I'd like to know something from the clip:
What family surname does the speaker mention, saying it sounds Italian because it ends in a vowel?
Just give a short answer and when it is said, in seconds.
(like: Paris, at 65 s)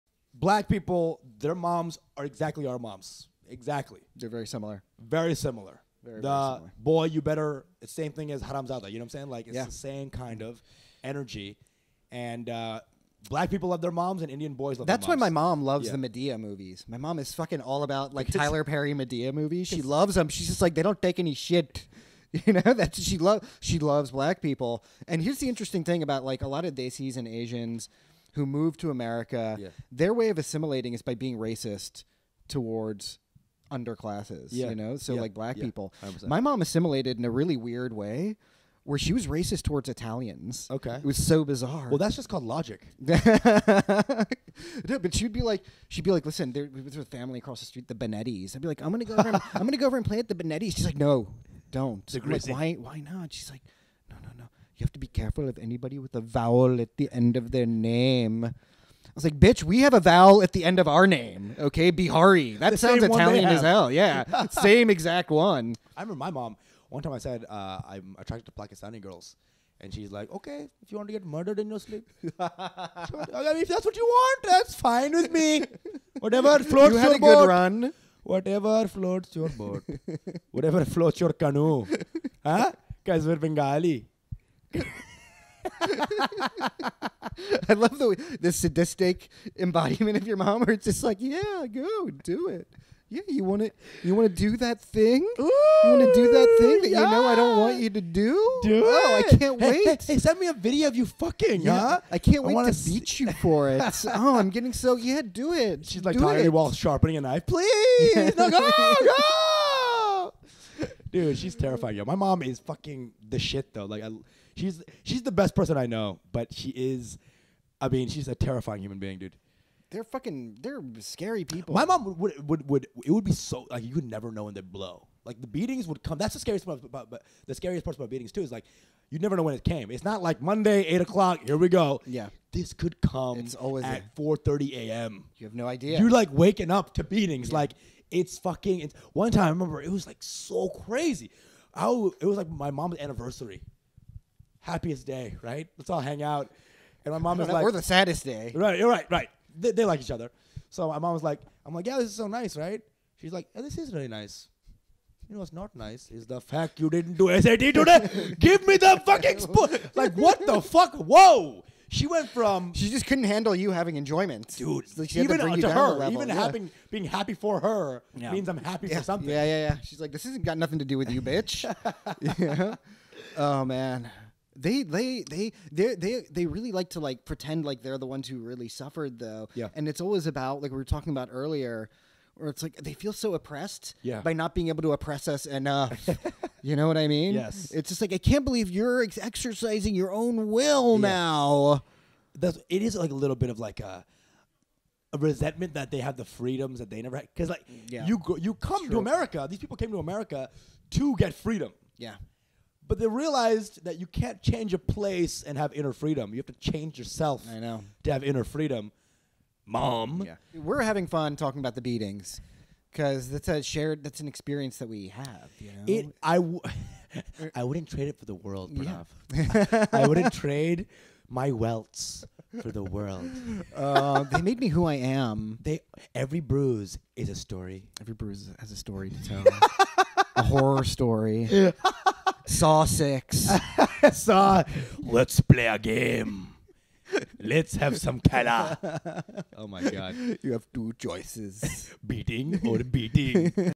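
Behari, at 61 s.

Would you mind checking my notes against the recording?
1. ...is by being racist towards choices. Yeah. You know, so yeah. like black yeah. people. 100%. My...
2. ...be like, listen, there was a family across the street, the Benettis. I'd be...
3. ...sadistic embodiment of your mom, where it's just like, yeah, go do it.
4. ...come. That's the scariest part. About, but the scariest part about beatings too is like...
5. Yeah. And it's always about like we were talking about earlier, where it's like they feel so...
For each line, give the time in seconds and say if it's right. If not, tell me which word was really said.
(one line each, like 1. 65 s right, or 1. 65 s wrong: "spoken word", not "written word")
1. 30 s wrong: "underclasses", not "choices"
2. 46 s right
3. 88 s right
4. 126 s right
5. 179 s right.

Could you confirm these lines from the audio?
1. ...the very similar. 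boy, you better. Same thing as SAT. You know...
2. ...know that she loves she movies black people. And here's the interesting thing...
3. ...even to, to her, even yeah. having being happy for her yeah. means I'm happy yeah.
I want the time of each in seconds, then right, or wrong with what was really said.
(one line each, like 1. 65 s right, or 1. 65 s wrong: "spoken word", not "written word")
1. 6 s wrong: "Haramzada", not "SAT"
2. 22 s wrong: "loves", not "movies"
3. 165 s right.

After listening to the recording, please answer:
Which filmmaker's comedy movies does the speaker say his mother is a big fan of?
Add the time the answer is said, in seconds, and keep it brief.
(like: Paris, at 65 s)
Tyler Perry, at 18 s.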